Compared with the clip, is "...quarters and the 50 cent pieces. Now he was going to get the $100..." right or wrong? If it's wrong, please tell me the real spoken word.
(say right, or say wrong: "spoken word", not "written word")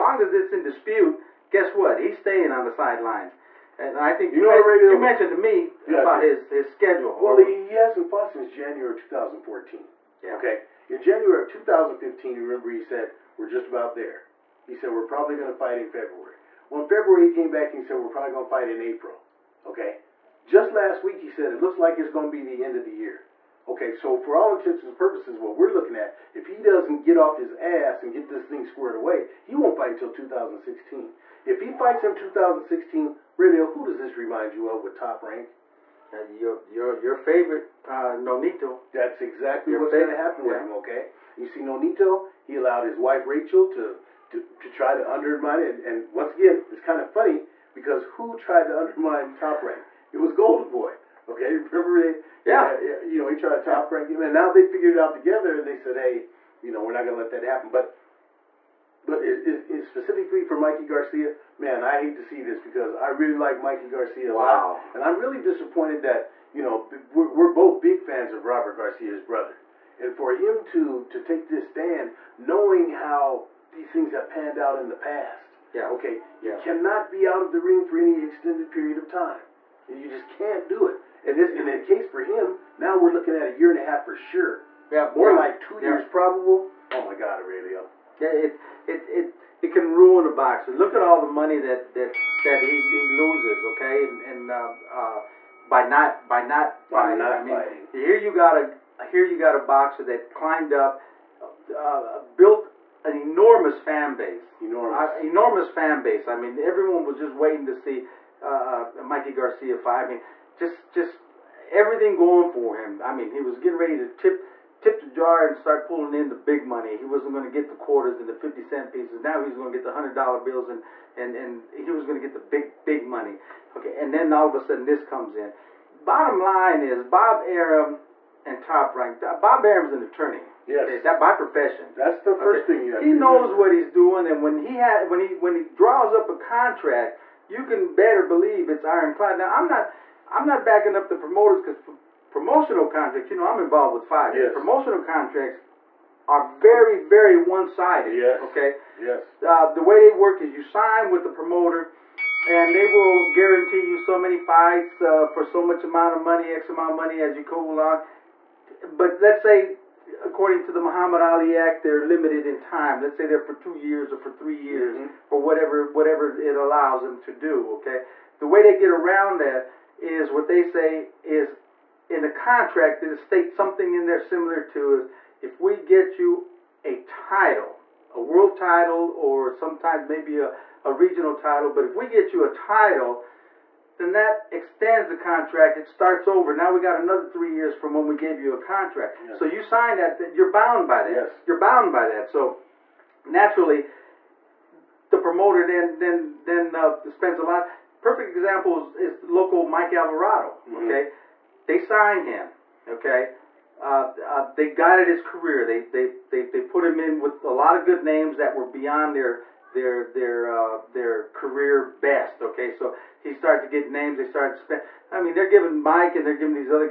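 right.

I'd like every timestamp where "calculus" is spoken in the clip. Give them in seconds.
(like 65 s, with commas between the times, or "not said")
not said.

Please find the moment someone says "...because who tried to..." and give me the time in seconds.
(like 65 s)
47 s.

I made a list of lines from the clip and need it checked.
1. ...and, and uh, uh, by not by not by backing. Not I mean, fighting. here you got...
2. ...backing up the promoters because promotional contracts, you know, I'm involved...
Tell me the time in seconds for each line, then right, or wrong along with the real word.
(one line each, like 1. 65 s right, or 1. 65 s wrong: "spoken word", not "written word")
1. 94 s wrong: "fighting", not "backing"
2. 140 s right.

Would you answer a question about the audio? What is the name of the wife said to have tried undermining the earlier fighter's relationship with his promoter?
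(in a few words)
Rachel.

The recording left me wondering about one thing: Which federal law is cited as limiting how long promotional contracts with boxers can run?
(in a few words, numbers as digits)
Muhammad Ali Act.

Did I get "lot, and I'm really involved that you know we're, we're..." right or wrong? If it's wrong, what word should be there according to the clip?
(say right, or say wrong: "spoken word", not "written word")
wrong: "disappointed", not "involved".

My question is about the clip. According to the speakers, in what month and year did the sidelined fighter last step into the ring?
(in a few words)
January 2014.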